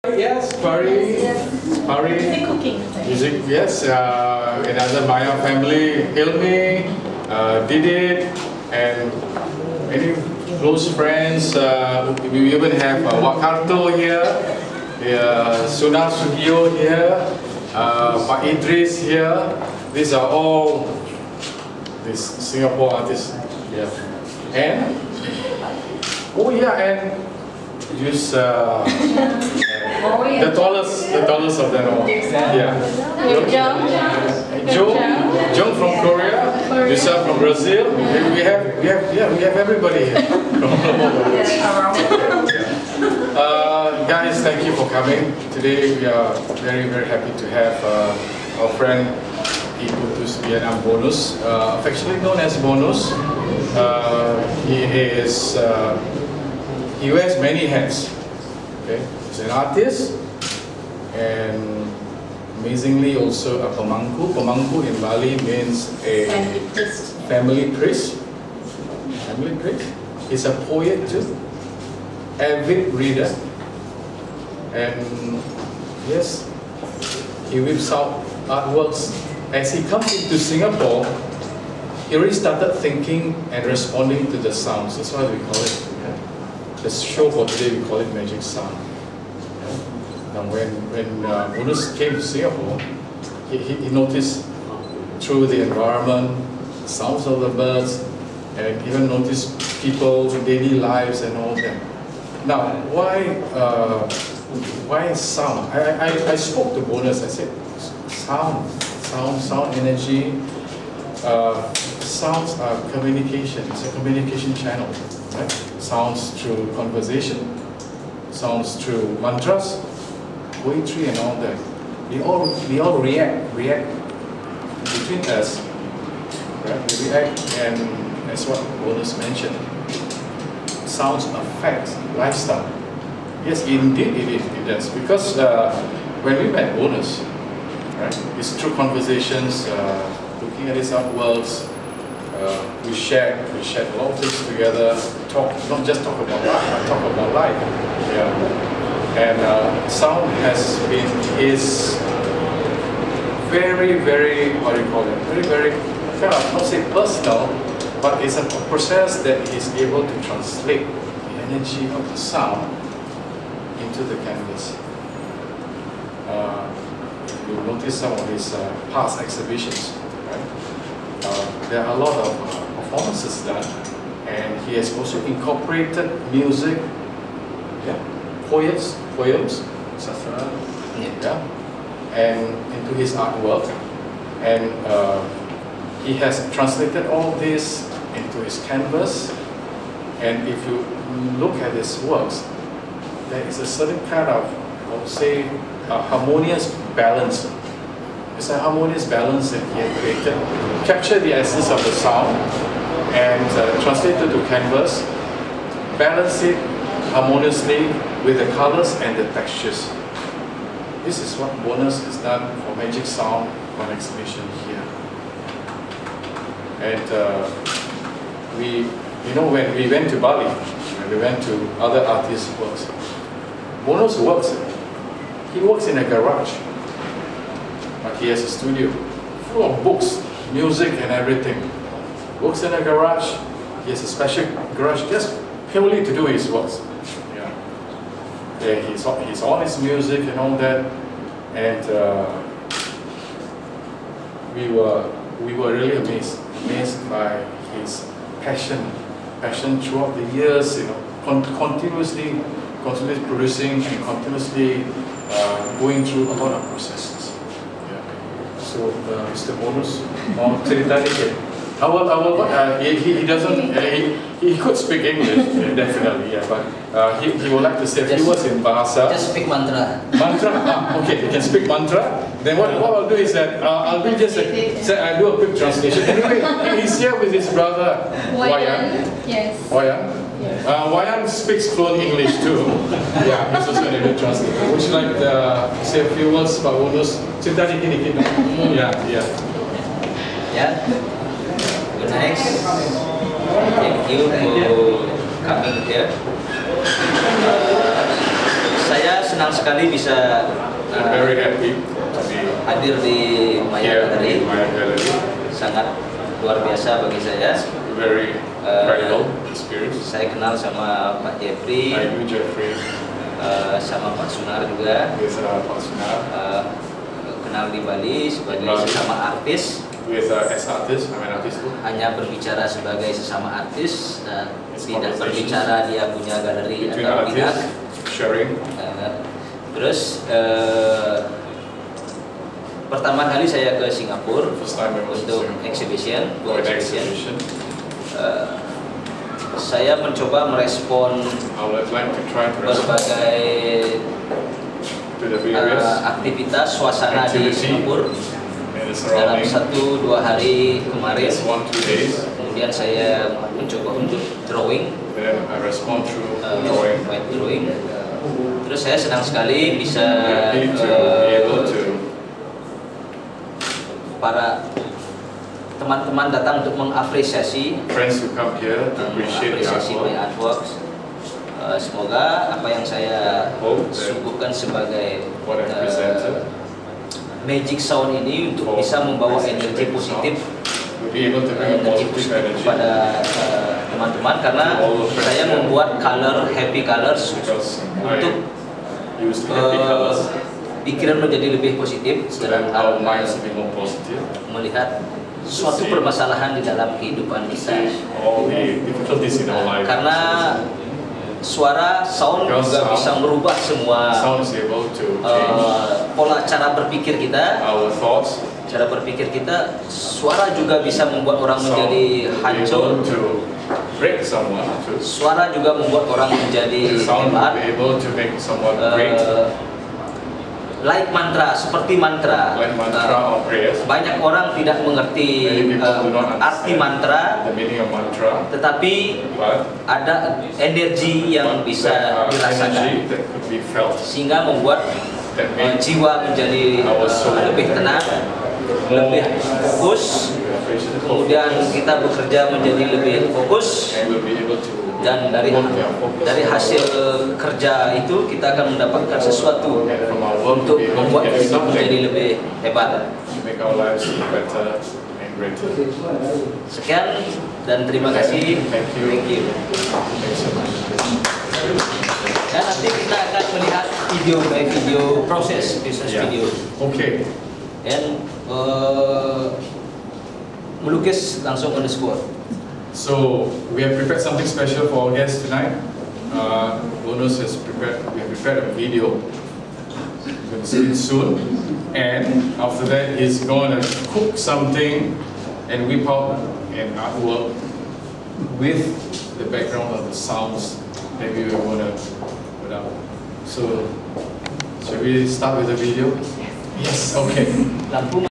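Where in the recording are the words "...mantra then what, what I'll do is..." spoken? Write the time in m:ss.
4:31.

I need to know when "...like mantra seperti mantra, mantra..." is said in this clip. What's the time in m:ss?
7:00.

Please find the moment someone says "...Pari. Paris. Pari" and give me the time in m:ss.
0:00.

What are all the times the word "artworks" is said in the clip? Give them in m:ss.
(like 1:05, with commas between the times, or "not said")
1:18, 2:20, 3:03, 6:10, 8:06.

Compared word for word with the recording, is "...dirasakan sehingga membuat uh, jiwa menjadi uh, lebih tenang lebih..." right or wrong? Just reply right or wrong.
right.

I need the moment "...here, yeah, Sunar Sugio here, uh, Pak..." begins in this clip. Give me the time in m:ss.
0:13.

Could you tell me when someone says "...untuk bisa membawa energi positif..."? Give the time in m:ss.
6:18.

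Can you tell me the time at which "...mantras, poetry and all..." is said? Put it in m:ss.
1:59.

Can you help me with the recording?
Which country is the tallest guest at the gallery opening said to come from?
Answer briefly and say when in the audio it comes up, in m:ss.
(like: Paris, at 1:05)
Korea, at 0:36.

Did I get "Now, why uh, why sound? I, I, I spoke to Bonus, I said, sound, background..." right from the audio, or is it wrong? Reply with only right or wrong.
wrong.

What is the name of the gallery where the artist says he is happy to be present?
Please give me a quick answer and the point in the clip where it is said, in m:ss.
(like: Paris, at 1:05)
Maya Gallery, at 5:03.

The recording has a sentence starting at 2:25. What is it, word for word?
Talk not just talk about life, but talk about life.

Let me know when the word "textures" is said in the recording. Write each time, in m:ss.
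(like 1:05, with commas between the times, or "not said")
3:29.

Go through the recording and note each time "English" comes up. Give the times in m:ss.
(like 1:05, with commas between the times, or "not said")
4:25, 4:42.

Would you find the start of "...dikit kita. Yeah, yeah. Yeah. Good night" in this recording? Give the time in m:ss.
4:47.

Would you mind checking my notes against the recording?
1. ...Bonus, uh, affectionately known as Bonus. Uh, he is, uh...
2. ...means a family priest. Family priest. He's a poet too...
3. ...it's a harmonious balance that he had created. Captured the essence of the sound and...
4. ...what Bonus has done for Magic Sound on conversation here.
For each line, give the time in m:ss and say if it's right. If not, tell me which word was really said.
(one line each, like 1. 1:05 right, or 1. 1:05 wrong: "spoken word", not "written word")
1. 0:50 right
2. 1:05 right
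3. 3:18 right
4. 3:31 wrong: "exhibition", not "conversation".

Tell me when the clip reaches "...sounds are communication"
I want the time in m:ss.
1:52.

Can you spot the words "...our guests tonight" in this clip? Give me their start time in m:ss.
7:55.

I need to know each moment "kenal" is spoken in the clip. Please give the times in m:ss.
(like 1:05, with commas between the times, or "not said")
5:10, 5:17.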